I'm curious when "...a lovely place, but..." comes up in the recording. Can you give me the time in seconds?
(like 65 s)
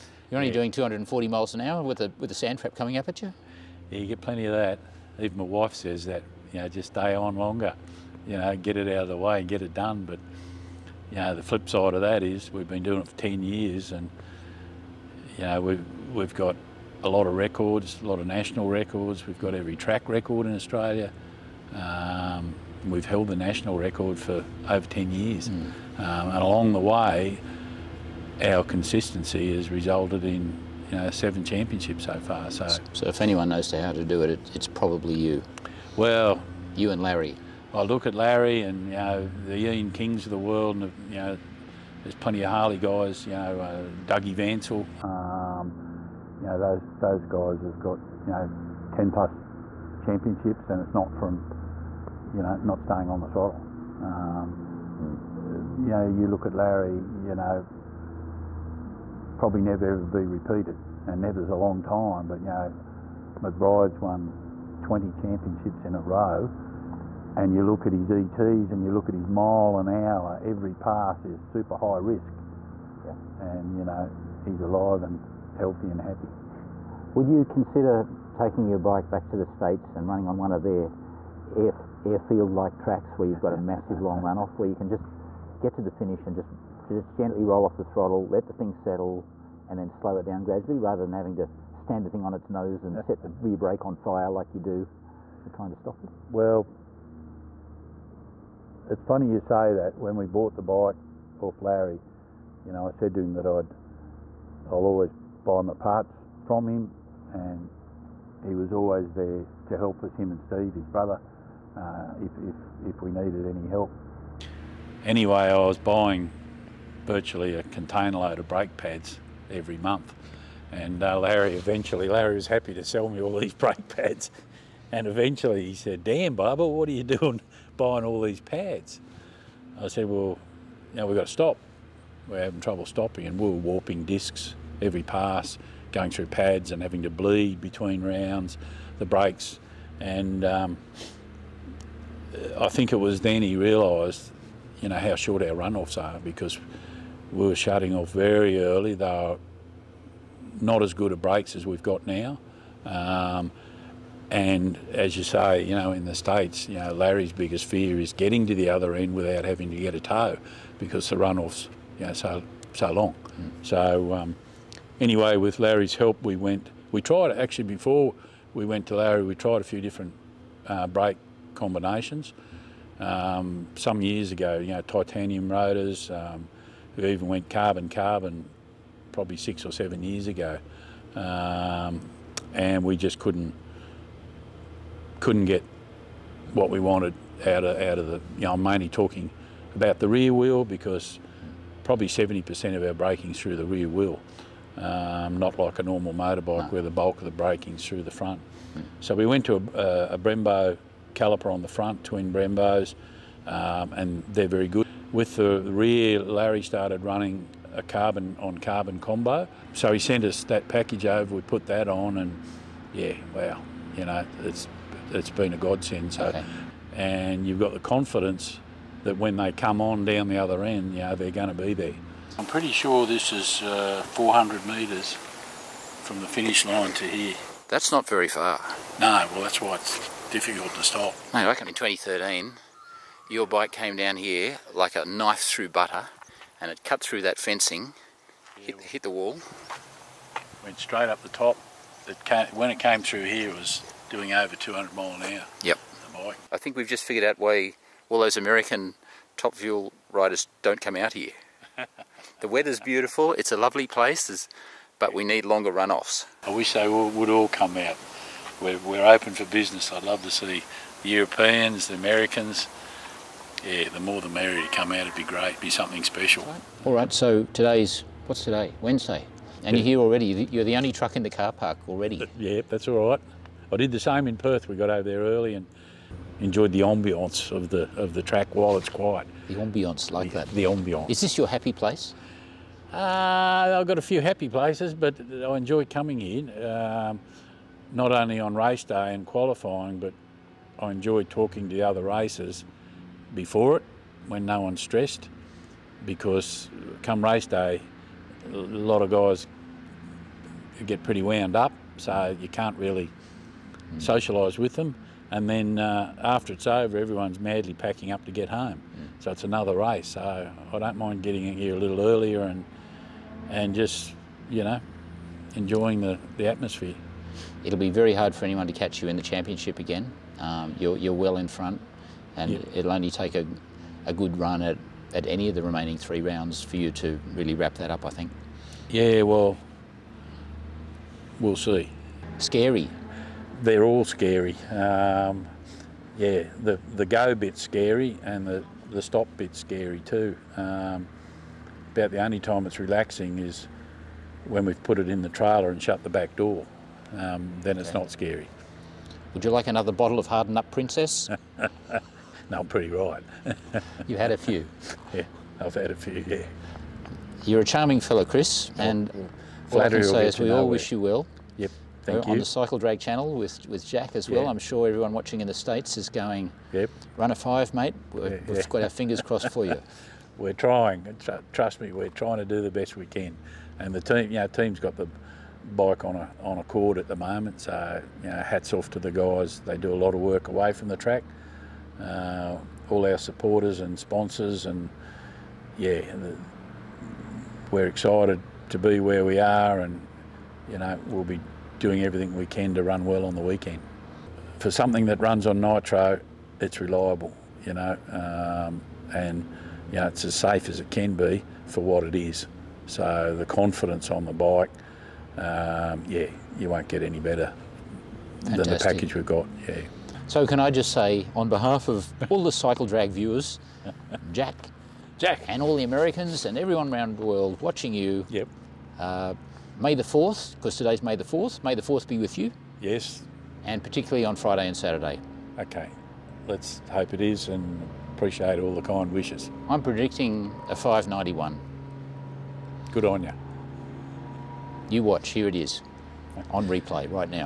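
253 s.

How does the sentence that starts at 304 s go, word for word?
socialise with them, and then uh, after it's over, everyone's madly packing up to get home.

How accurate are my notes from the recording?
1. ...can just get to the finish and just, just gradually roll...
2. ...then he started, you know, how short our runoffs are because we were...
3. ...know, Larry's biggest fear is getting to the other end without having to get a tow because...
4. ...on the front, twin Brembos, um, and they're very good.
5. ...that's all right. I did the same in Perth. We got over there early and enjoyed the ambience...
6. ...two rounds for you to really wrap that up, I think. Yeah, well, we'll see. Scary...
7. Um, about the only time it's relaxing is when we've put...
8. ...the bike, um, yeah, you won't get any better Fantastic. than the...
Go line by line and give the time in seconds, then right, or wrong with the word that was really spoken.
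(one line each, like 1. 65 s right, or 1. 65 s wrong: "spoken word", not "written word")
1. 84 s wrong: "gently", not "gradually"
2. 143 s wrong: "realised", not "started"
3. 156 s right
4. 201 s right
5. 272 s right
6. 325 s wrong: "three", not "two"
7. 340 s right
8. 404 s right.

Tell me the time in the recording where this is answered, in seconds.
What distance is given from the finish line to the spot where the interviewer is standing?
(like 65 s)
224 s.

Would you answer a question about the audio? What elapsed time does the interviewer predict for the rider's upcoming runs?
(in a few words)
591.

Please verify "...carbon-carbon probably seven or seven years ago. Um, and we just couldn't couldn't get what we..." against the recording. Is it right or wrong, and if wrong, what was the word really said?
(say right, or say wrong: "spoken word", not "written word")
wrong: "six", not "seven".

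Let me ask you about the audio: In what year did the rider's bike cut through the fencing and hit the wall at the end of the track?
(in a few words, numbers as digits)
2013.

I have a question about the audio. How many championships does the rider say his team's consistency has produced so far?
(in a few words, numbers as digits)
7.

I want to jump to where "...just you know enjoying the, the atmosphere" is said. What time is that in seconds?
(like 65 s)
313 s.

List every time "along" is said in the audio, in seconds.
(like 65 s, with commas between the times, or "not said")
26 s.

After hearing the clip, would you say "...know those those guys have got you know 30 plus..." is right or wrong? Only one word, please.
wrong.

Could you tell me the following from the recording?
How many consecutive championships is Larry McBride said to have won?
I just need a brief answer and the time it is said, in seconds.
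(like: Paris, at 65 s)
20, at 64 s.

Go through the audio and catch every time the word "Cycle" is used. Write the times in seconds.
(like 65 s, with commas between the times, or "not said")
362 s, 412 s.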